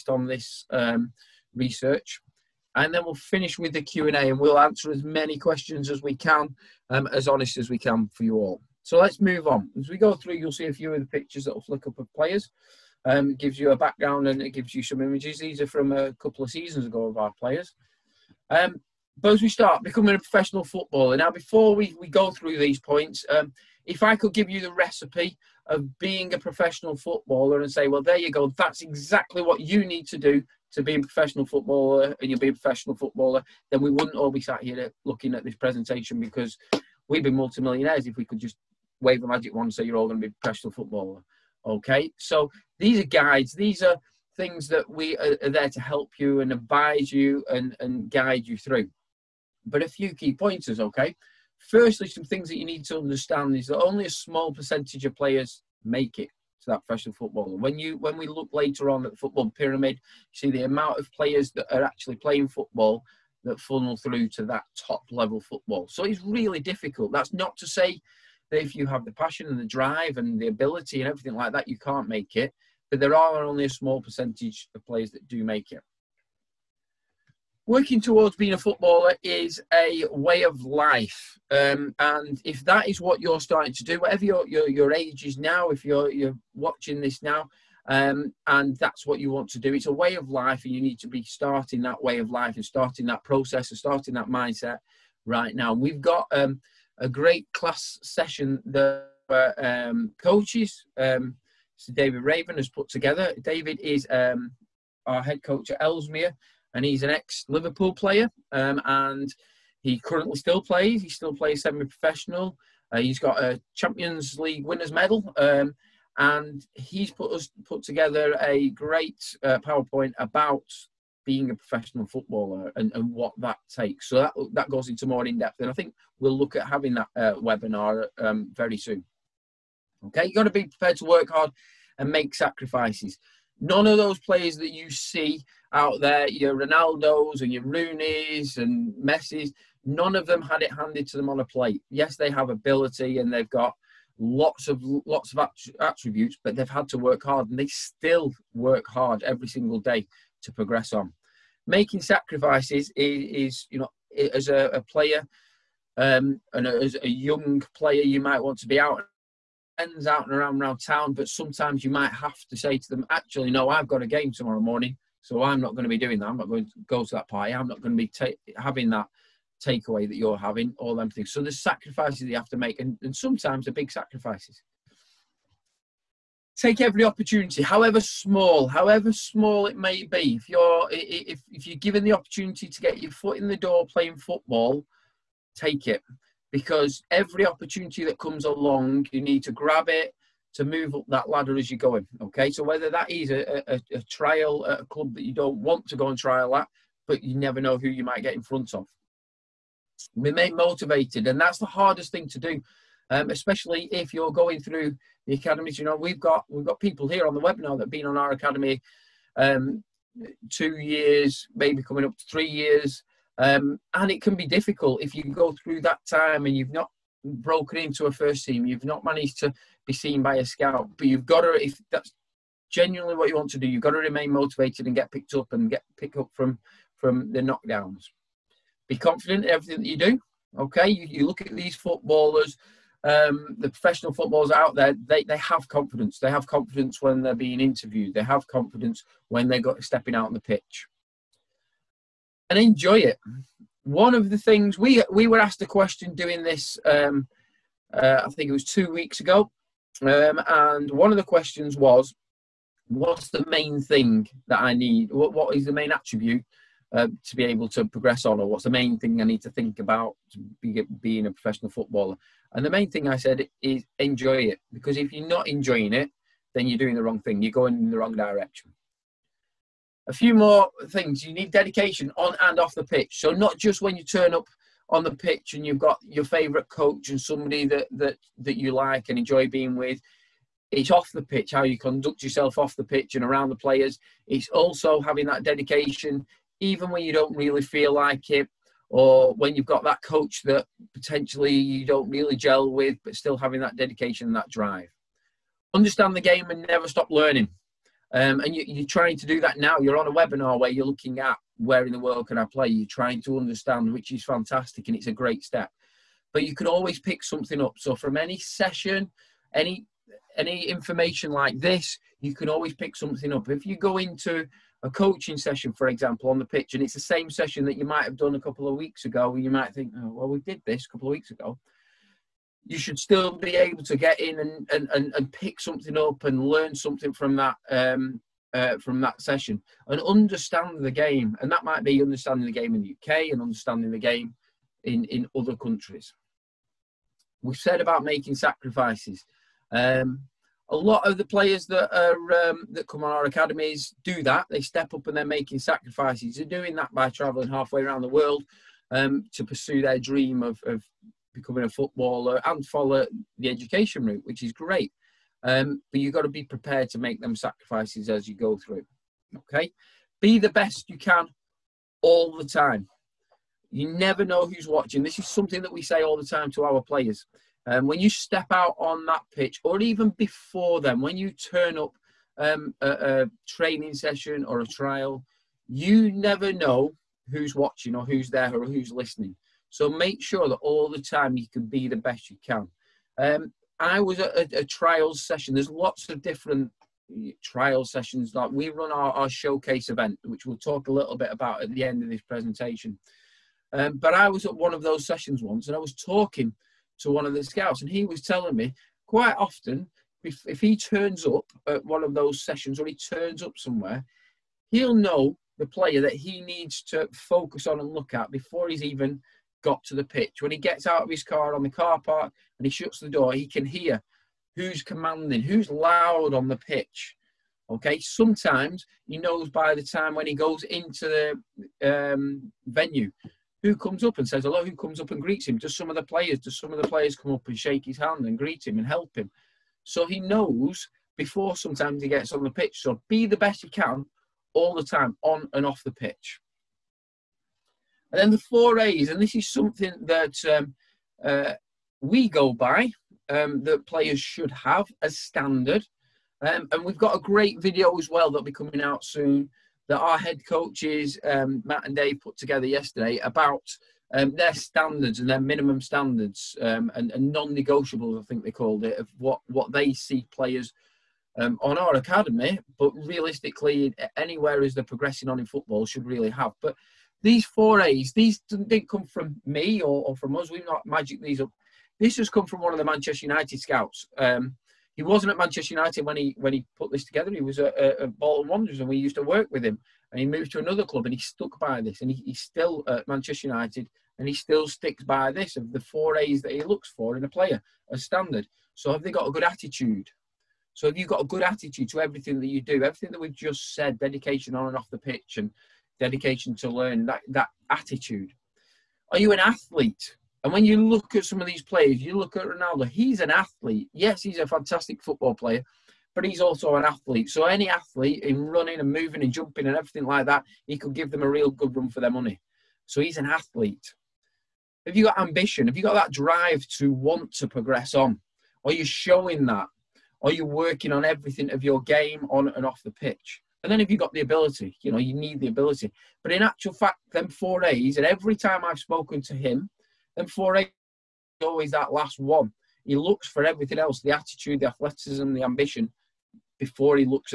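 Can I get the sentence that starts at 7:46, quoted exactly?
But these four A's, these didn't come from me or, or from us.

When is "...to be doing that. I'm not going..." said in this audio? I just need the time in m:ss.
2:45.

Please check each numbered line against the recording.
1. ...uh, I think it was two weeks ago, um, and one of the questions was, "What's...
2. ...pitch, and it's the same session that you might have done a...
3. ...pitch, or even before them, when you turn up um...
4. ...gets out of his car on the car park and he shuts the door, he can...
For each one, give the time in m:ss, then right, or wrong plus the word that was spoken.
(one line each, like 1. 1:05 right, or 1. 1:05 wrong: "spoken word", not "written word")
1. 4:07 right
2. 5:16 right
3. 6:09 right
4. 6:50 right.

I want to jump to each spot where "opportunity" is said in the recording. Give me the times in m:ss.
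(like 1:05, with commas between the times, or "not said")
2:57, 3:02, 3:07.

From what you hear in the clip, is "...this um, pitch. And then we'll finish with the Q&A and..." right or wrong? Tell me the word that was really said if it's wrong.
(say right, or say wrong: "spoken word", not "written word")
wrong: "research", not "pitch".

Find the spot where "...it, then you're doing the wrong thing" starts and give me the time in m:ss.
4:25.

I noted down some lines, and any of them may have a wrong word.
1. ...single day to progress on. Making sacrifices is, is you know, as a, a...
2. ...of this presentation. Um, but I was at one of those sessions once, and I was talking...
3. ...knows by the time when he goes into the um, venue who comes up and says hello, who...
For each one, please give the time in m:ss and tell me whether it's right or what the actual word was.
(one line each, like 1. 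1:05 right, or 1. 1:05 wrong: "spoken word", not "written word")
1. 2:29 right
2. 6:32 right
3. 6:59 right.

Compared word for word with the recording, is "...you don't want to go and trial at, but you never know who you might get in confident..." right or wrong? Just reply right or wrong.
wrong.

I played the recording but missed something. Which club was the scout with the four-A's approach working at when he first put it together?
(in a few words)
Bolton Wanderers.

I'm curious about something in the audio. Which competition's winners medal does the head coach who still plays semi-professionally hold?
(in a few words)
Champions League.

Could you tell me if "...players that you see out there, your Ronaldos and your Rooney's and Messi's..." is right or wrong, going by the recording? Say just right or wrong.
right.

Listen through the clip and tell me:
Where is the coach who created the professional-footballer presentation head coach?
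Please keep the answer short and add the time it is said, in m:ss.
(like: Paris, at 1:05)
Ellesmere, at 1:45.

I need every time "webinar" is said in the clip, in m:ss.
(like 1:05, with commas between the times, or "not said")
2:07, 3:27, 5:00.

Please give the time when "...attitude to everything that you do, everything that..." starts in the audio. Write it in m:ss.
8:11.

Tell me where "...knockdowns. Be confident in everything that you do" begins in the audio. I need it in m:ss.
3:47.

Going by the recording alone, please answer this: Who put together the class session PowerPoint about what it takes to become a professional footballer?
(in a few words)
David Raven.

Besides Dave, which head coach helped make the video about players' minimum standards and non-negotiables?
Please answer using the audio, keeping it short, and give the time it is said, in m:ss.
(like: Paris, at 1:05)
Matt, at 7:31.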